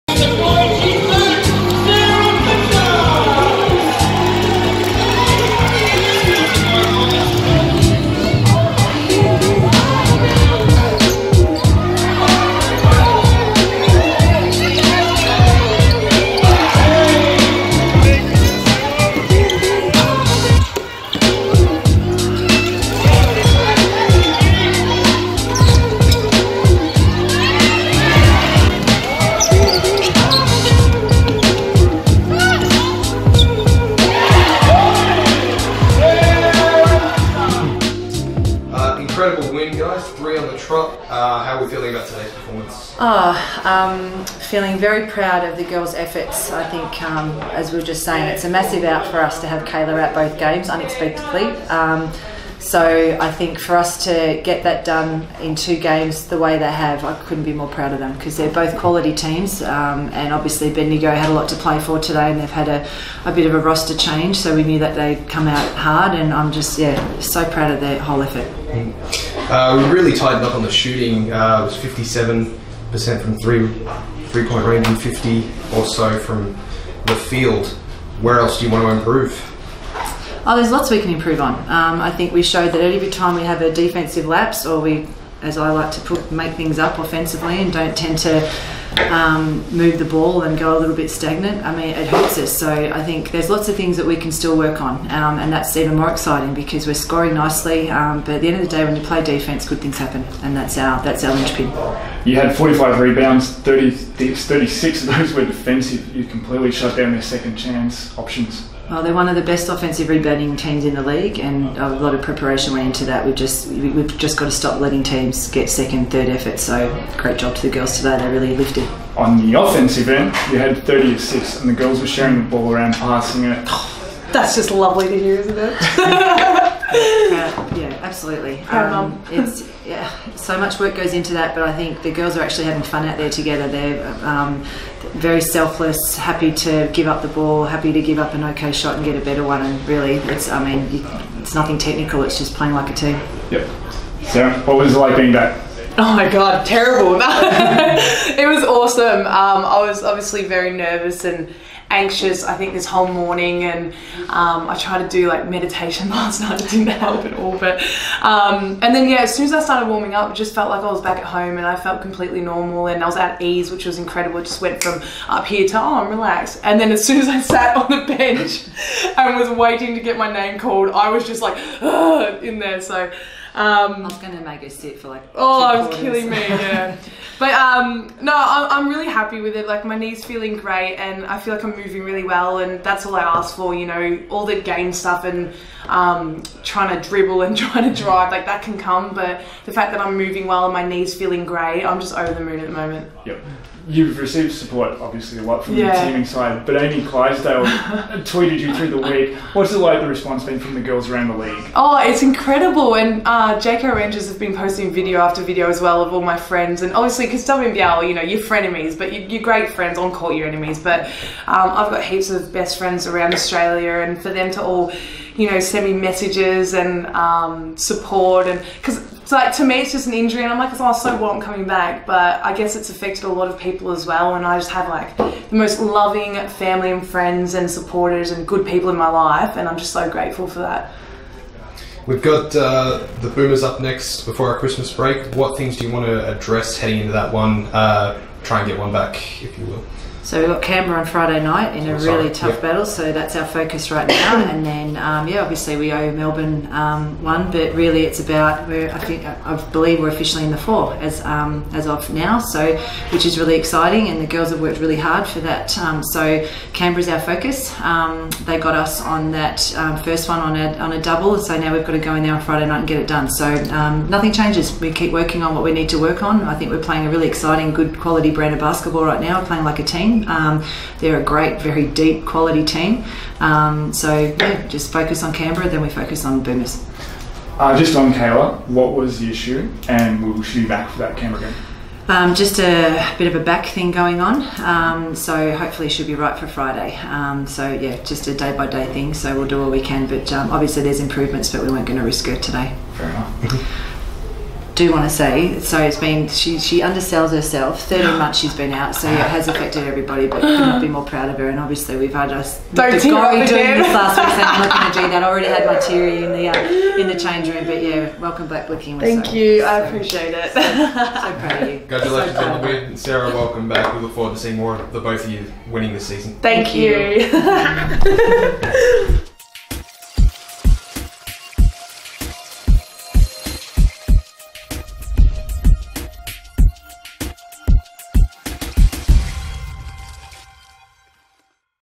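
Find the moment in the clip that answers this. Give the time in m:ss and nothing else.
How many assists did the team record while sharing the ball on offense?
2:00.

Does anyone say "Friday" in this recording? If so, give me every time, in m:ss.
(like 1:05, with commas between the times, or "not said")
4:01, 4:22, 4:46.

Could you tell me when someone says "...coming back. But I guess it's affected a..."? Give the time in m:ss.
3:41.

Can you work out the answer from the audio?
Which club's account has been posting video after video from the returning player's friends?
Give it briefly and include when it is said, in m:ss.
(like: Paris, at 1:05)
Jayco Rangers, at 3:23.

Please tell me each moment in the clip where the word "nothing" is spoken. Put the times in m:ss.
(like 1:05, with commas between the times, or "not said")
2:21, 4:24.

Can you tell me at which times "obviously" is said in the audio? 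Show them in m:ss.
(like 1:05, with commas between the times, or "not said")
1:00, 2:30, 3:14, 3:26, 4:05, 4:50, 5:01.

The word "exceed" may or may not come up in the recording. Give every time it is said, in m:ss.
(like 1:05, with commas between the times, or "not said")
not said.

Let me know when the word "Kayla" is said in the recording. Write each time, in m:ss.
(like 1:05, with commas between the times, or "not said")
0:49, 4:38.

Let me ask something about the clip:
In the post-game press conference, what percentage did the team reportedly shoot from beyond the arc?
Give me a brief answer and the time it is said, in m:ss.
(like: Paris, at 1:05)
57%, at 1:11.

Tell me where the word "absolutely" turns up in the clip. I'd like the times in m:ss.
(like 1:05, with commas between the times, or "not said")
2:08.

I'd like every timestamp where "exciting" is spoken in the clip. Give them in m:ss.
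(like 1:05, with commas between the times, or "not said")
1:36, 4:13, 4:27.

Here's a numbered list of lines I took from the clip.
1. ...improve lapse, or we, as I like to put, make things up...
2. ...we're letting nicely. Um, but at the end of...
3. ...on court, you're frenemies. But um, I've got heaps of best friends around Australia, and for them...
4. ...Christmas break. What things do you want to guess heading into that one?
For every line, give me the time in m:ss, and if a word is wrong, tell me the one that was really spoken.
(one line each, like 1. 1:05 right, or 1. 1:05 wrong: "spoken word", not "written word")
1. 1:23 wrong: "defensive", not "improve"
2. 1:36 wrong: "scoring", not "letting"
3. 3:29 wrong: "enemies", not "frenemies"
4. 3:54 wrong: "address", not "guess".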